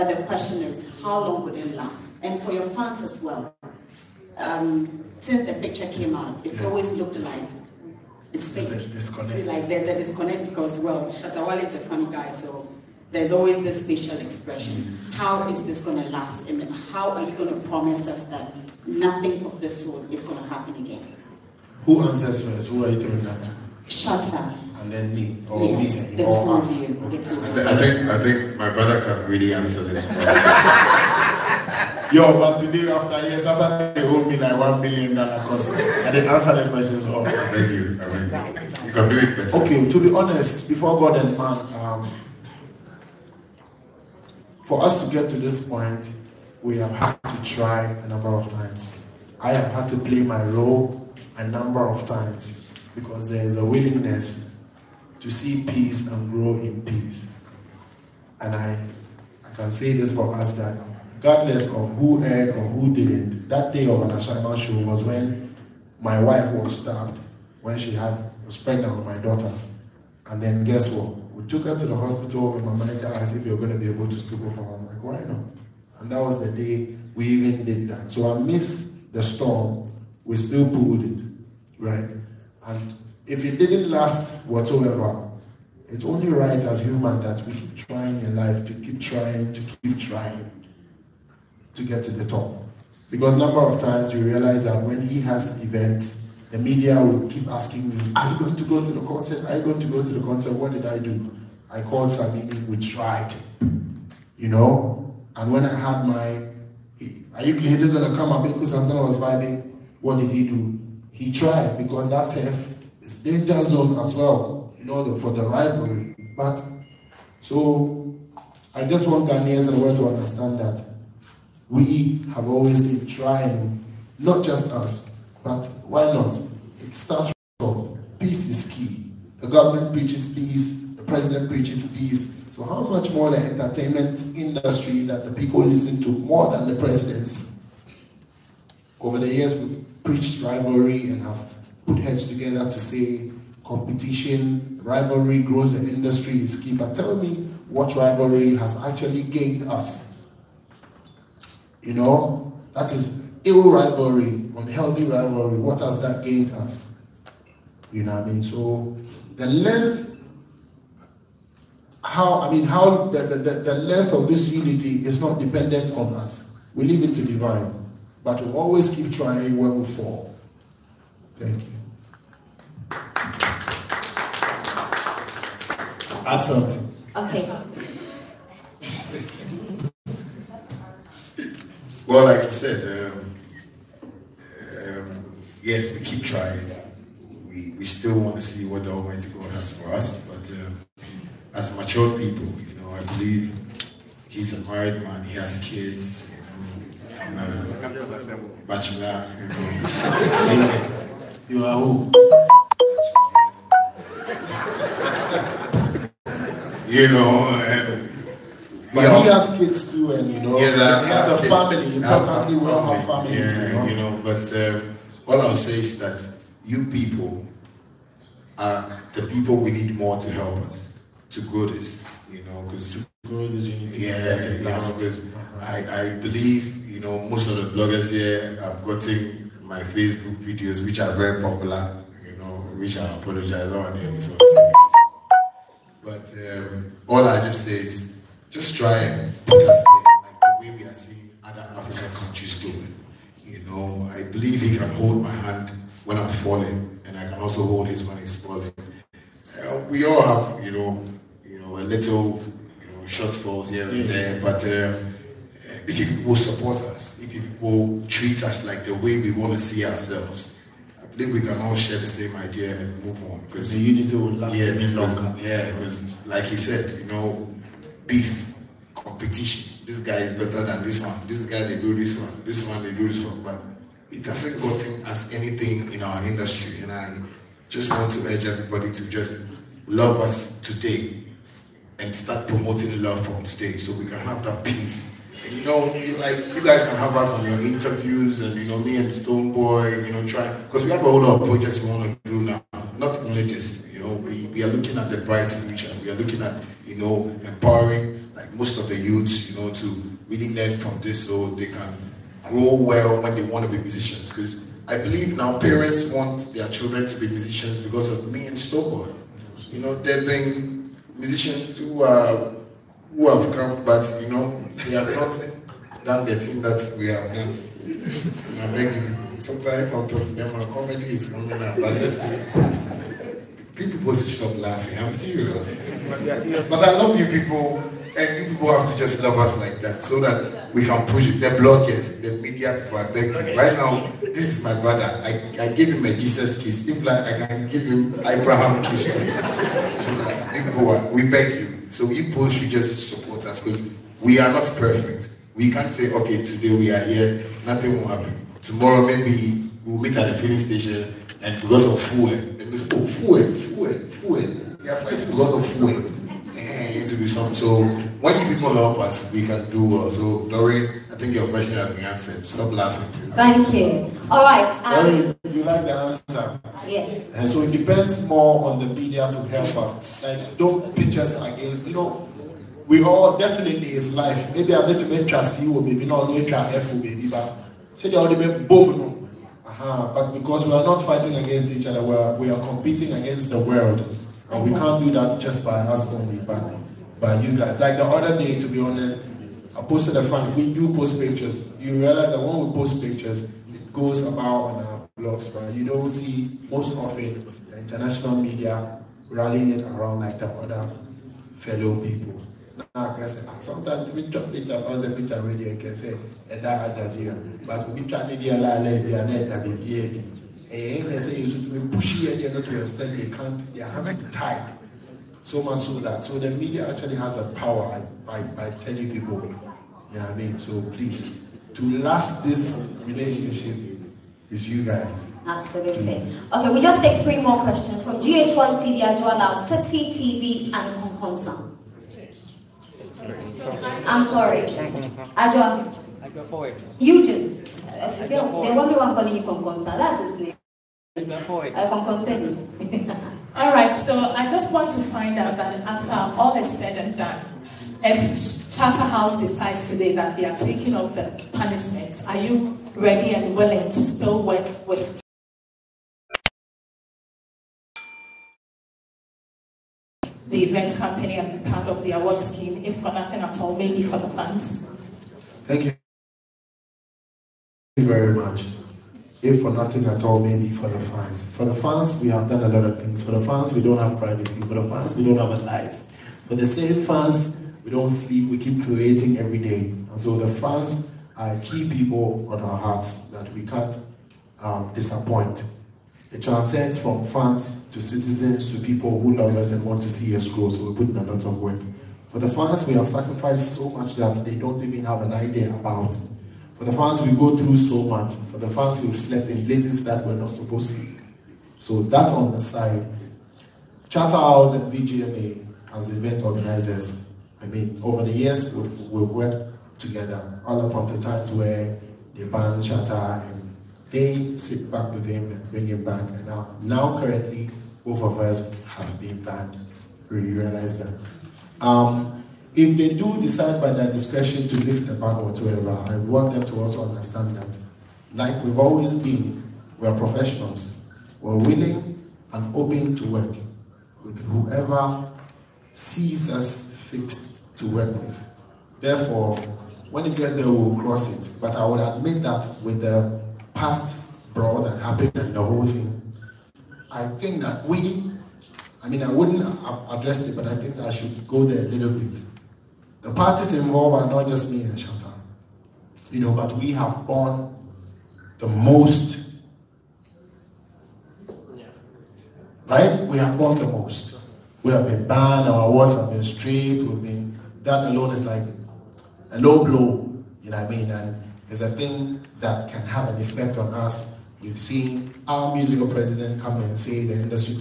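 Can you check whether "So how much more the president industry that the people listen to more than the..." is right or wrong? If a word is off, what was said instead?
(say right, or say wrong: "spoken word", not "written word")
wrong: "entertainment", not "president".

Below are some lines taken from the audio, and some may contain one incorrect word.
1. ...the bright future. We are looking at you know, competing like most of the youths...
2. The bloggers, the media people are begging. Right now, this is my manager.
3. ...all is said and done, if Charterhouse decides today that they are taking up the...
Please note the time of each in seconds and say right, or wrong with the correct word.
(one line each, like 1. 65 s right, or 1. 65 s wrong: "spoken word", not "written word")
1. 295 s wrong: "empowering", not "competing"
2. 331 s wrong: "brother", not "manager"
3. 446 s right.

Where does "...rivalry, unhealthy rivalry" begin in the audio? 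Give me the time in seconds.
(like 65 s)
153 s.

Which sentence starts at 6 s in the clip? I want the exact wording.
always looked like it's there's a disconnect.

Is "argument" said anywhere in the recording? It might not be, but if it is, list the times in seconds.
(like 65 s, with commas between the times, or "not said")
not said.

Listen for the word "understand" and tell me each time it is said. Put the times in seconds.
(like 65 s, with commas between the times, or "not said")
120 s, 527 s.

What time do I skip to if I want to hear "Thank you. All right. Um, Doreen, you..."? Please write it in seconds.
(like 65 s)
363 s.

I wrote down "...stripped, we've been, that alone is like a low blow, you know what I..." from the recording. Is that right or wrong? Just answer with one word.
right.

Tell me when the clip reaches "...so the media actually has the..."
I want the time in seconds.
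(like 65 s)
416 s.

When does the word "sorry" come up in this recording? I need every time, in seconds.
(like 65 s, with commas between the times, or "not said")
434 s.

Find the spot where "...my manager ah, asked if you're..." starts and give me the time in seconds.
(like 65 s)
72 s.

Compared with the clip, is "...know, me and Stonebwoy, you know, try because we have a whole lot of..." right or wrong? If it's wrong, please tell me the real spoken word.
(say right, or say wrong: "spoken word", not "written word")
right.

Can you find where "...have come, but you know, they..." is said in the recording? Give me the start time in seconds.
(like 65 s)
313 s.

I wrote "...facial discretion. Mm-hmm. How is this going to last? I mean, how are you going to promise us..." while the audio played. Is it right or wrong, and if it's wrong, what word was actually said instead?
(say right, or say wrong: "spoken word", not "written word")
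wrong: "expression", not "discretion".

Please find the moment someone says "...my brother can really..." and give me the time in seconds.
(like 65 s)
28 s.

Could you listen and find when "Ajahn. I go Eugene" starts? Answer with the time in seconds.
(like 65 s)
435 s.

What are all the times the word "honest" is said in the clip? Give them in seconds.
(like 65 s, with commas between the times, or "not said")
40 s, 388 s.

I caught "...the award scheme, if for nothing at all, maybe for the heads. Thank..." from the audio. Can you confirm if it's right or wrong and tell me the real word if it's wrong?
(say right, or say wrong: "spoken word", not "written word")
wrong: "funds", not "heads".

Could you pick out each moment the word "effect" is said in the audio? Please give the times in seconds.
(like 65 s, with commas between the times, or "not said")
573 s.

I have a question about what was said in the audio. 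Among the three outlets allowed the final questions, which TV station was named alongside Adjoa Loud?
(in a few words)
GH1 TV.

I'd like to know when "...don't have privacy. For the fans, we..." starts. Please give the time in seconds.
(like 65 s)
473 s.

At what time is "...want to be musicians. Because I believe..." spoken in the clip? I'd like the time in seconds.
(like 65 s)
303 s.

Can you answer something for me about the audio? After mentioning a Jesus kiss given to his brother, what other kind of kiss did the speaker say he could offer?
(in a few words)
Abraham kiss.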